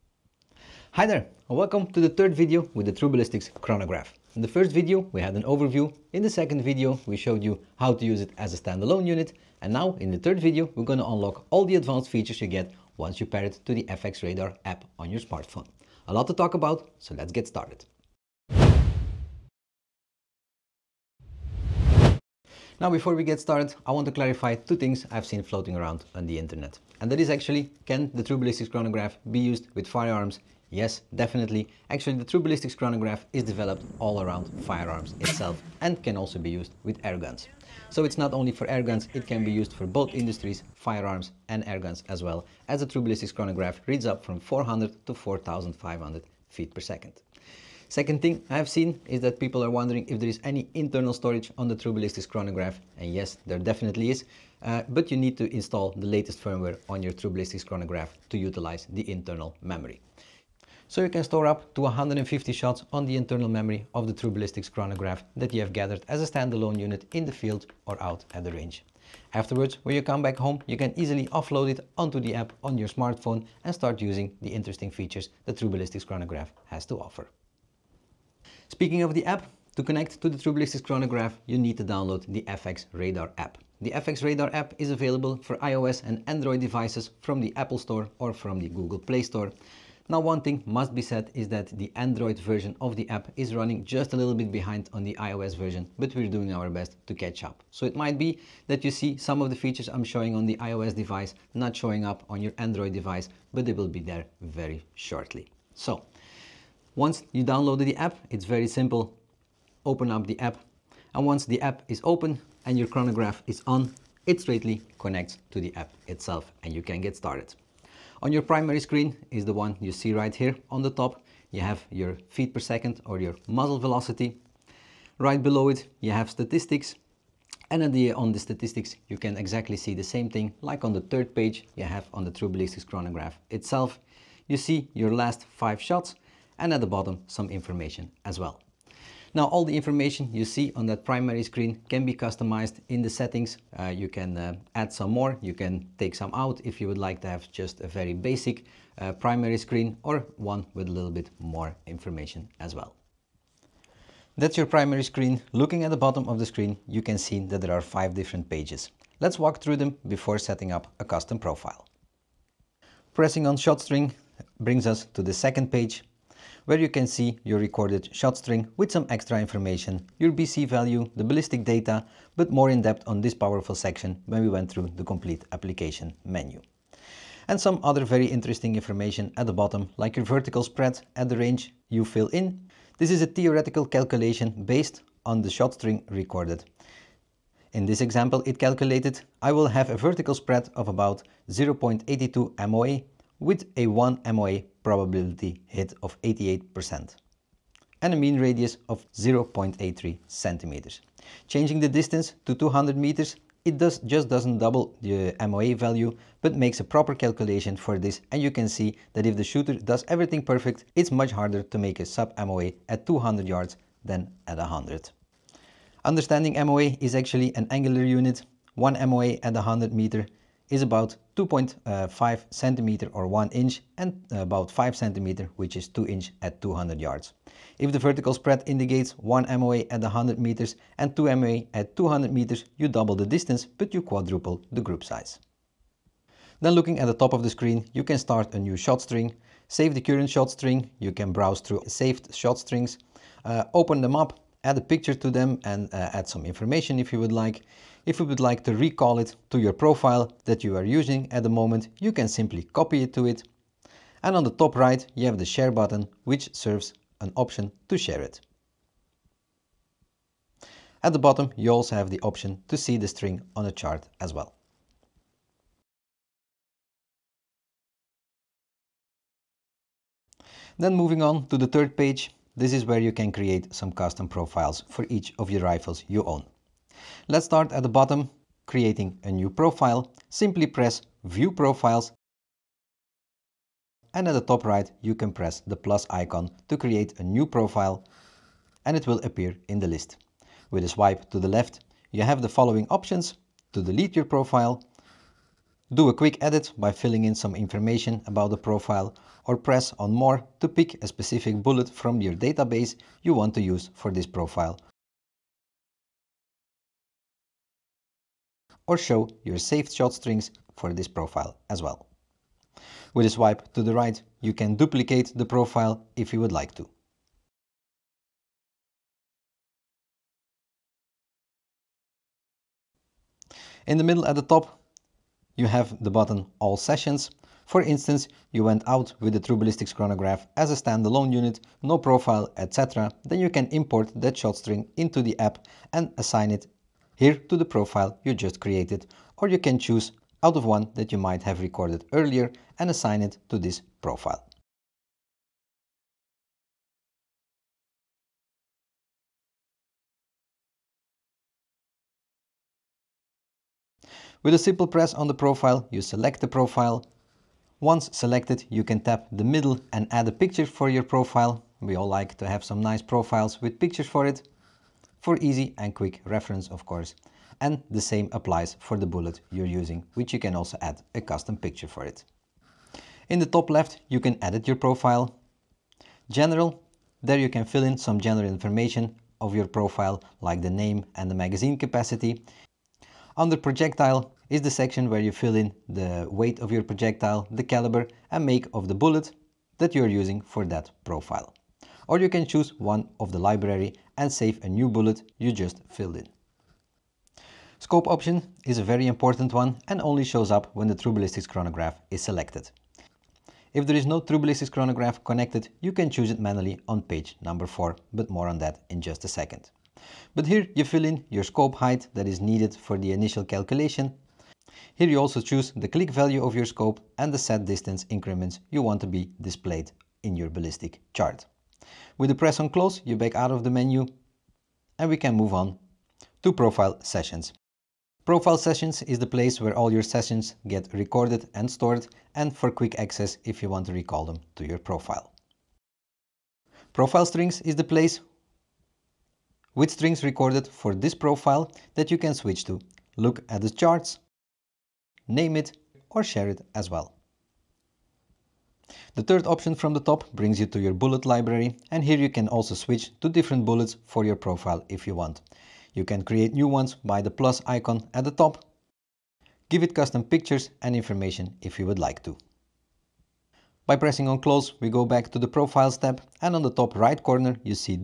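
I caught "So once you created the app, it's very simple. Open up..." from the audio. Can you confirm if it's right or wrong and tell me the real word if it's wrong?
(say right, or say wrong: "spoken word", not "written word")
wrong: "downloaded", not "created".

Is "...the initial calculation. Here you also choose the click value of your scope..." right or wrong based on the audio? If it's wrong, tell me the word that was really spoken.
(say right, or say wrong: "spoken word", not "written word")
right.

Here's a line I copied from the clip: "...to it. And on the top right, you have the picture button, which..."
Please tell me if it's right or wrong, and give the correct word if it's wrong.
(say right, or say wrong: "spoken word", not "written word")
wrong: "share", not "picture".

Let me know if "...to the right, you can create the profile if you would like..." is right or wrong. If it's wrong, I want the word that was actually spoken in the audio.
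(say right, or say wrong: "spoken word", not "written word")
wrong: "duplicate", not "create".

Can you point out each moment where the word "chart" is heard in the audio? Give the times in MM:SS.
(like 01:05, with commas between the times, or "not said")
04:23, 07:01, 07:23.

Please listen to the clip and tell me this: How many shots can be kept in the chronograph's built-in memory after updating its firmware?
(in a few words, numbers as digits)
150.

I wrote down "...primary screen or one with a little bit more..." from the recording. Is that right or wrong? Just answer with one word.
right.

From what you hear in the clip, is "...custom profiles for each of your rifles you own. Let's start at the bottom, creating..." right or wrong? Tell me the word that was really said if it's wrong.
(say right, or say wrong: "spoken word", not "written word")
right.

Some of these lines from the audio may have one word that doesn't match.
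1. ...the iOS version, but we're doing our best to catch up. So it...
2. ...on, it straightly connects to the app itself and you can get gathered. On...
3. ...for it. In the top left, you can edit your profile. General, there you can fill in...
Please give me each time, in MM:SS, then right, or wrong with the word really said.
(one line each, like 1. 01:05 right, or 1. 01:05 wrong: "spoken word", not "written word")
1. 01:35 right
2. 01:53 wrong: "started", not "gathered"
3. 06:11 right.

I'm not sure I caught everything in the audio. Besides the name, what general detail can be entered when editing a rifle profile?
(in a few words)
magazine capacity.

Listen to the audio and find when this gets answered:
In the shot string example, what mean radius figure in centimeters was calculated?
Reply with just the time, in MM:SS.
03:19.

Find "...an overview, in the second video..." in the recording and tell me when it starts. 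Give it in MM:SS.
00:05.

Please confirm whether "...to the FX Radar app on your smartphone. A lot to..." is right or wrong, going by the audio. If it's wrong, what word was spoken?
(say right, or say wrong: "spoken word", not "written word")
right.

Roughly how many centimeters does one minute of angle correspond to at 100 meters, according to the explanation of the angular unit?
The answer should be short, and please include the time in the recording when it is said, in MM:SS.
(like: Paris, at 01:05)
2.5 centimeters, at 03:41.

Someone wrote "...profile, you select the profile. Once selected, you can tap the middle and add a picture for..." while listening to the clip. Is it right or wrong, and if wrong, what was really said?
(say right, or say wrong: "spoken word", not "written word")
right.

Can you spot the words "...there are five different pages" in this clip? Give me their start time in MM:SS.
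02:37.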